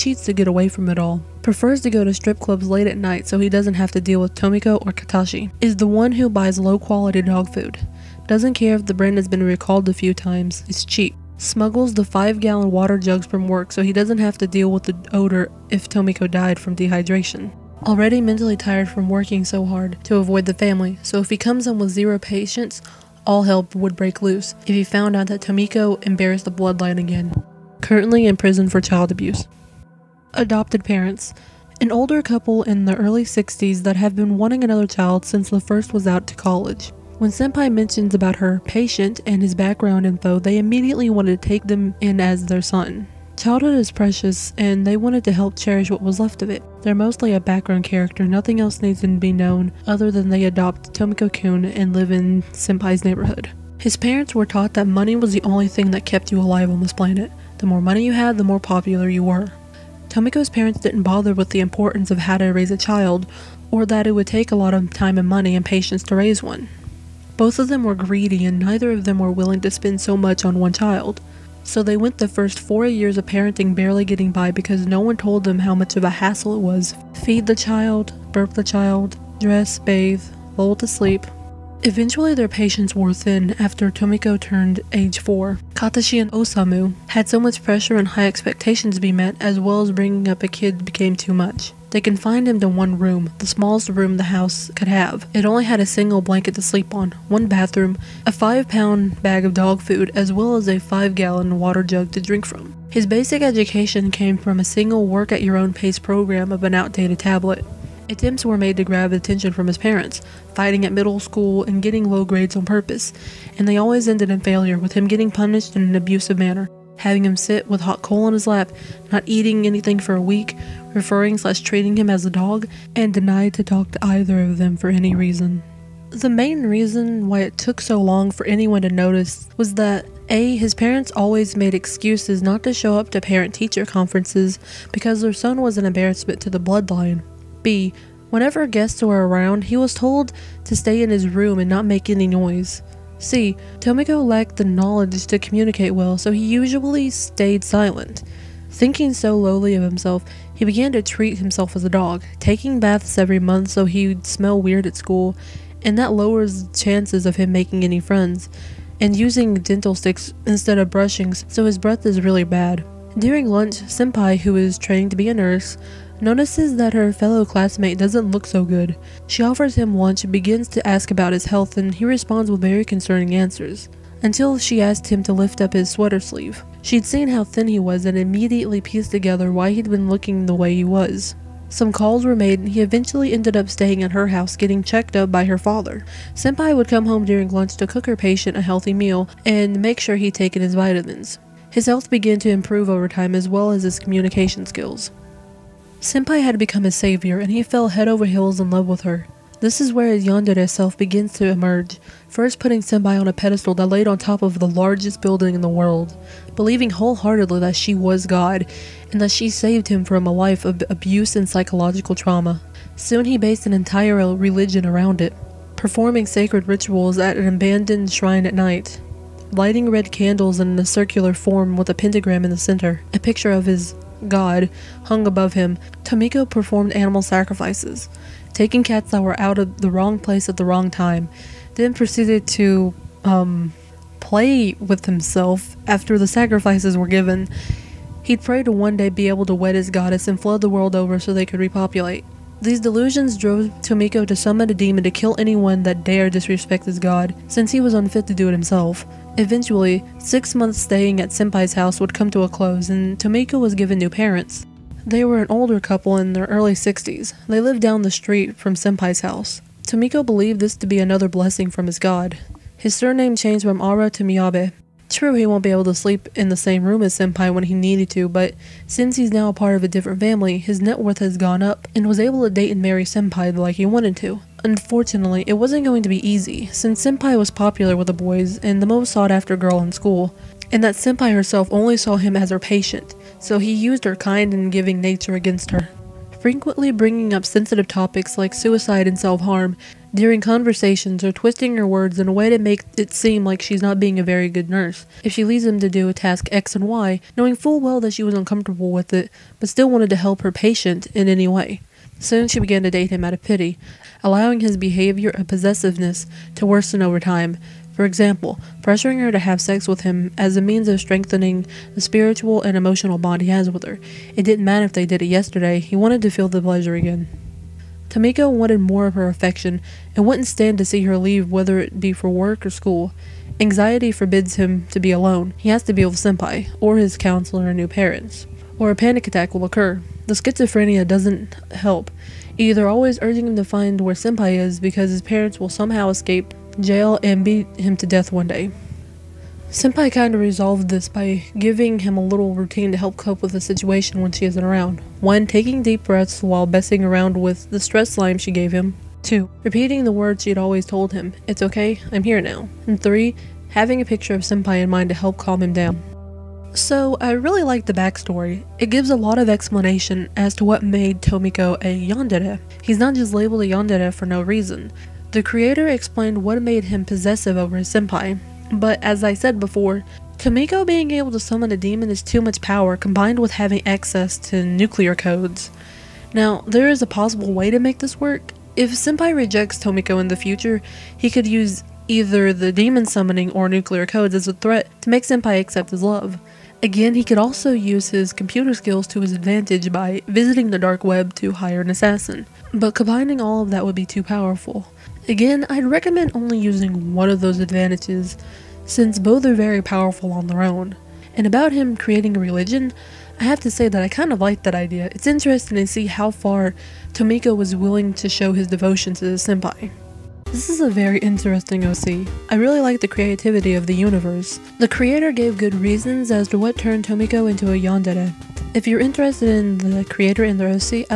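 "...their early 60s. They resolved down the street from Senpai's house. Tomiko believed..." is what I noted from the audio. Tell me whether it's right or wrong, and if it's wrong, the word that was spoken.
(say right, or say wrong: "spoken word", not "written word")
wrong: "lived", not "resolved".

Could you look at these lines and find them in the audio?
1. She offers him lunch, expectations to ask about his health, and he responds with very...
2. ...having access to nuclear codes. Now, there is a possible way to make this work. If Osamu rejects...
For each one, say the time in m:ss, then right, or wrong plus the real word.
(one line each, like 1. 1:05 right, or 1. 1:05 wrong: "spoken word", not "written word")
1. 2:49 wrong: "begins", not "expectations"
2. 6:13 wrong: "Senpai", not "Osamu".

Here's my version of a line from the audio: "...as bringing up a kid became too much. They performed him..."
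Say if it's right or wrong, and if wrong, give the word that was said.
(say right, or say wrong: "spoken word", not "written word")
wrong: "confined", not "performed".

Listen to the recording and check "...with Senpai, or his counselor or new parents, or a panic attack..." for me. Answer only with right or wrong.
right.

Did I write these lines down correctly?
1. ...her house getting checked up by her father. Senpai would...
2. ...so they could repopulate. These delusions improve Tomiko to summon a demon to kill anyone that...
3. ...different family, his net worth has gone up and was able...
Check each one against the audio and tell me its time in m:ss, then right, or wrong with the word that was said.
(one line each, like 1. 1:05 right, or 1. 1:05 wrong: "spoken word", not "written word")
1. 3:04 right
2. 4:01 wrong: "drove", not "improve"
3. 4:29 right.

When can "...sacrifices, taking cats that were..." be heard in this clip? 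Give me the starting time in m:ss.
3:47.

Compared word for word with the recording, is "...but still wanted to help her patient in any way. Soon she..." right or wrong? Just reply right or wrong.
right.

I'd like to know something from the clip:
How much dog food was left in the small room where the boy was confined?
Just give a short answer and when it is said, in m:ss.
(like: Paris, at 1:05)
5 pound bag, at 1:38.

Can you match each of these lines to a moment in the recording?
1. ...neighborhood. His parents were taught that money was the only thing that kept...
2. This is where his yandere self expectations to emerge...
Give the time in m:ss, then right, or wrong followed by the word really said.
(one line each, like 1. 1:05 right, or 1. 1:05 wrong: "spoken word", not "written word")
1. 0:53 right
2. 3:19 wrong: "begins", not "expectations".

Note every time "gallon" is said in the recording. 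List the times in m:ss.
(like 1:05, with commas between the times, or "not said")
0:12, 1:41.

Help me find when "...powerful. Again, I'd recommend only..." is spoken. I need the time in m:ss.
6:34.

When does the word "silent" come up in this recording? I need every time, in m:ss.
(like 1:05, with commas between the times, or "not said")
2:27.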